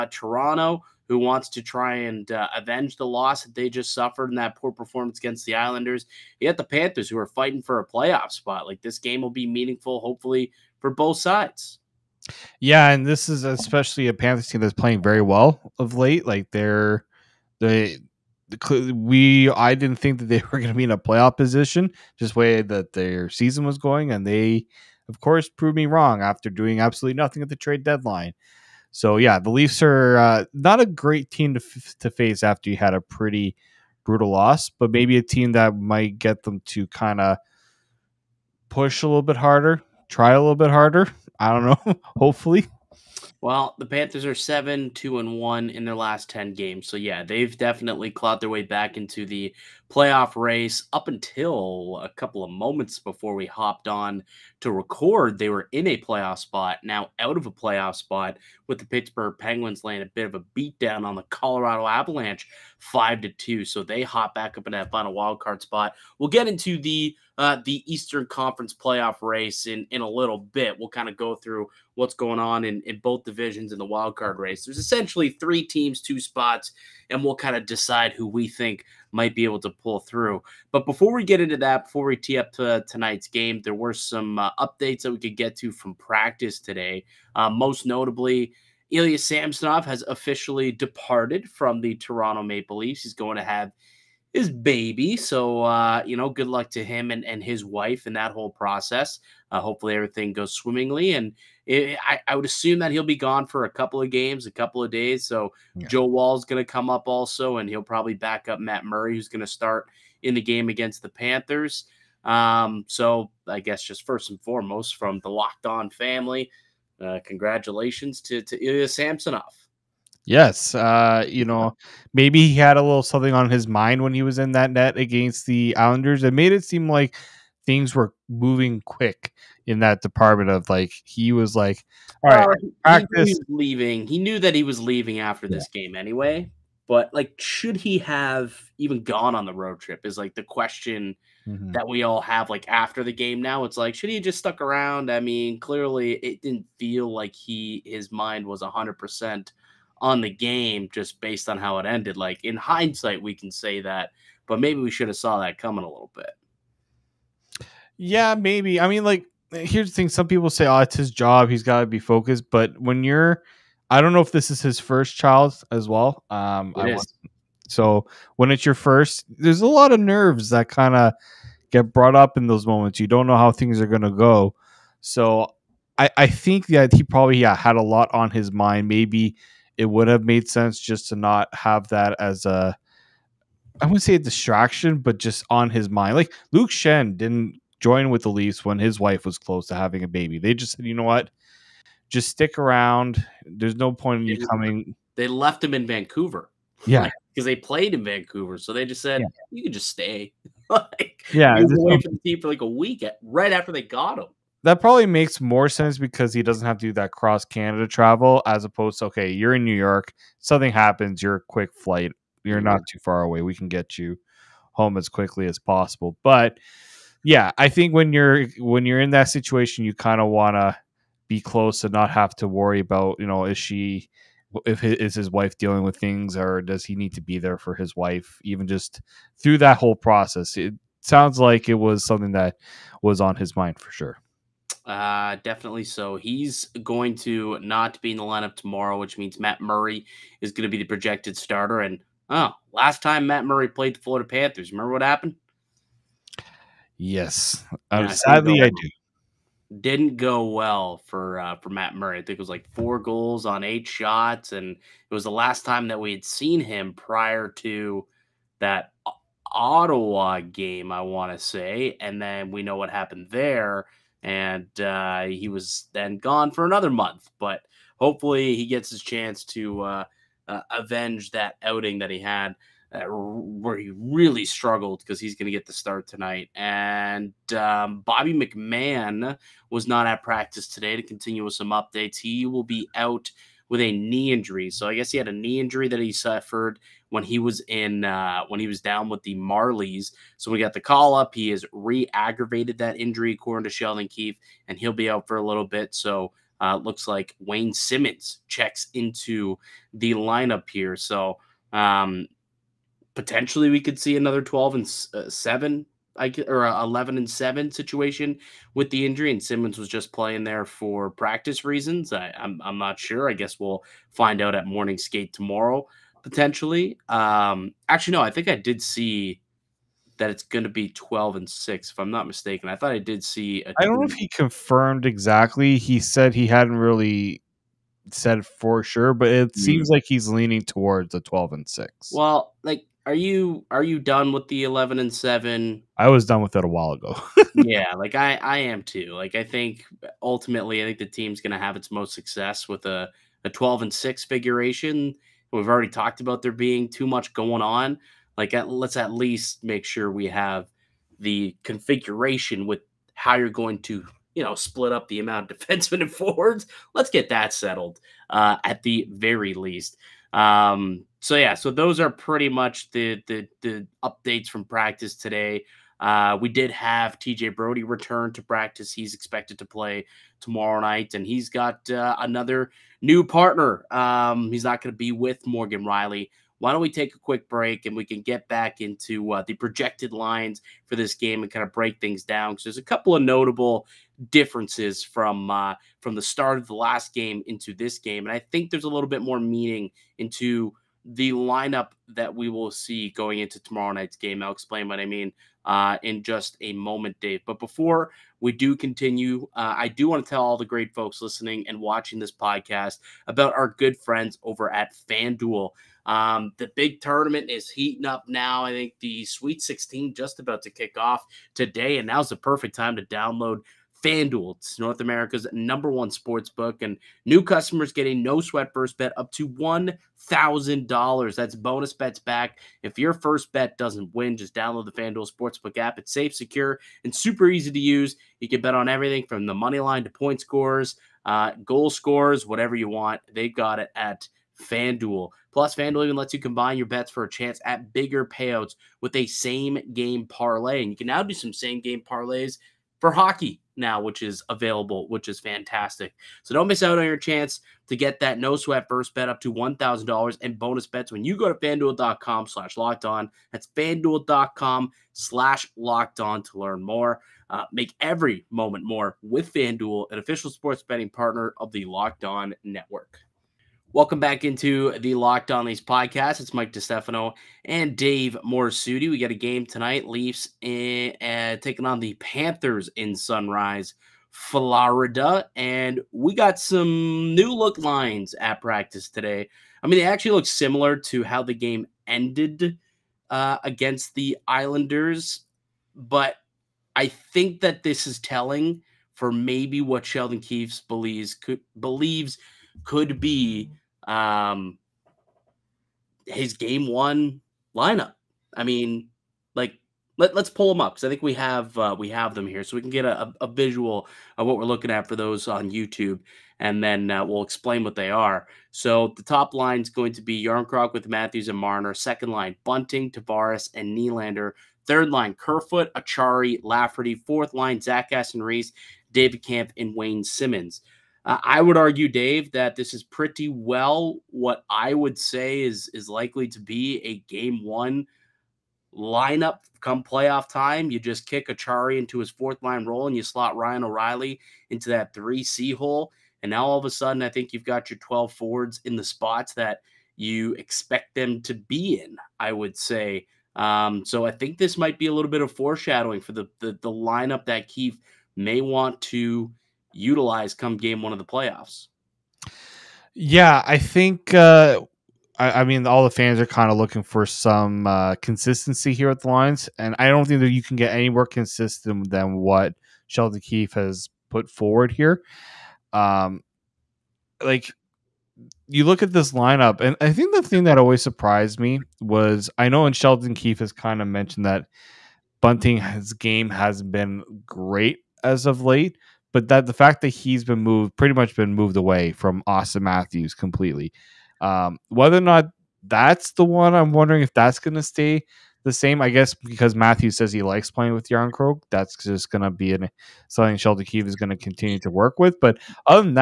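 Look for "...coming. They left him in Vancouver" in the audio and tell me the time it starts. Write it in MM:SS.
03:14.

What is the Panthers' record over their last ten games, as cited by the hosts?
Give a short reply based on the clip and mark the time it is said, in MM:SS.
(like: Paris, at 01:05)
7-2-1, at 00:44.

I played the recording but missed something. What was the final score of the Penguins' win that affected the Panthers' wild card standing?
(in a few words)
5-2.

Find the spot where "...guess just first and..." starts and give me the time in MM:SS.
01:53.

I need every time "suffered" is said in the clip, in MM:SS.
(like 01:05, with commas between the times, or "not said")
00:03, 04:46.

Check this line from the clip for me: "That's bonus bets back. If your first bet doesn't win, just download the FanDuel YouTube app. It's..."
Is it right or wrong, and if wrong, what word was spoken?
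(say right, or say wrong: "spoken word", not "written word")
wrong: "Sportsbook", not "YouTube".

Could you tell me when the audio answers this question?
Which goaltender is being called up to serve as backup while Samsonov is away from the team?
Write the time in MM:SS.
01:45.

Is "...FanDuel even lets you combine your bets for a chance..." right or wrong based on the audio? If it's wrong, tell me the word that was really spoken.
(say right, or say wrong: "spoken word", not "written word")
right.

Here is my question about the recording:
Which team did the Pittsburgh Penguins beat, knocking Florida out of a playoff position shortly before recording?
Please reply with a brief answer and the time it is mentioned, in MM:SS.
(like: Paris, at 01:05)
Colorado Avalanche, at 01:01.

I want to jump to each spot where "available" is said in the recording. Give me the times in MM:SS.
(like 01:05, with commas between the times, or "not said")
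07:24.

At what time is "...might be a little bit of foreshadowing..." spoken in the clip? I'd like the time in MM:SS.
09:04.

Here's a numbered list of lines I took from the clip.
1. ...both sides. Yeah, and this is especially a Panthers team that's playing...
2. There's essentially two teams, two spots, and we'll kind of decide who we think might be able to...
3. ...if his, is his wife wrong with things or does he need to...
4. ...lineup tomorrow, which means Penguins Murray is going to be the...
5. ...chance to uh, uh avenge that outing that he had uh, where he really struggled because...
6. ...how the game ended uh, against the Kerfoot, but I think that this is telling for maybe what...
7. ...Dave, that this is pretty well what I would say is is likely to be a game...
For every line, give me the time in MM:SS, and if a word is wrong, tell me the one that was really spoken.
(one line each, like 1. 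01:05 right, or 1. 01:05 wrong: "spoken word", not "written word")
1. 00:10 right
2. 01:14 wrong: "three", not "two"
3. 03:44 wrong: "dealing", not "wrong"
4. 03:58 wrong: "Matt", not "Penguins"
5. 04:29 right
6. 08:01 wrong: "Islanders", not "Kerfoot"
7. 08:42 right.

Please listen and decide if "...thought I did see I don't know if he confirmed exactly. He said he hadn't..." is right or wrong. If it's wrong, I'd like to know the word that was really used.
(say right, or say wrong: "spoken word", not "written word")
right.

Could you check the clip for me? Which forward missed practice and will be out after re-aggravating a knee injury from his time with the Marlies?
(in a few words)
Bobby McMann.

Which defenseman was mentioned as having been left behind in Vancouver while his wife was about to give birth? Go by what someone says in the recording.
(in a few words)
Luke Schenn.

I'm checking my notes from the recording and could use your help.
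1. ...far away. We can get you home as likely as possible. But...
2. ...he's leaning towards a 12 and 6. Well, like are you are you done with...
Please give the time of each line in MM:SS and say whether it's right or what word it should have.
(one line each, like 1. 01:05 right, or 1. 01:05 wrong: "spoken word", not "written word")
1. 03:32 wrong: "quickly", not "likely"
2. 05:30 right.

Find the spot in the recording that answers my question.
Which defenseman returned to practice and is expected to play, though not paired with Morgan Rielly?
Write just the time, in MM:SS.
06:07.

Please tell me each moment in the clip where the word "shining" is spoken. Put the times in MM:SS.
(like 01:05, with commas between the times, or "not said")
not said.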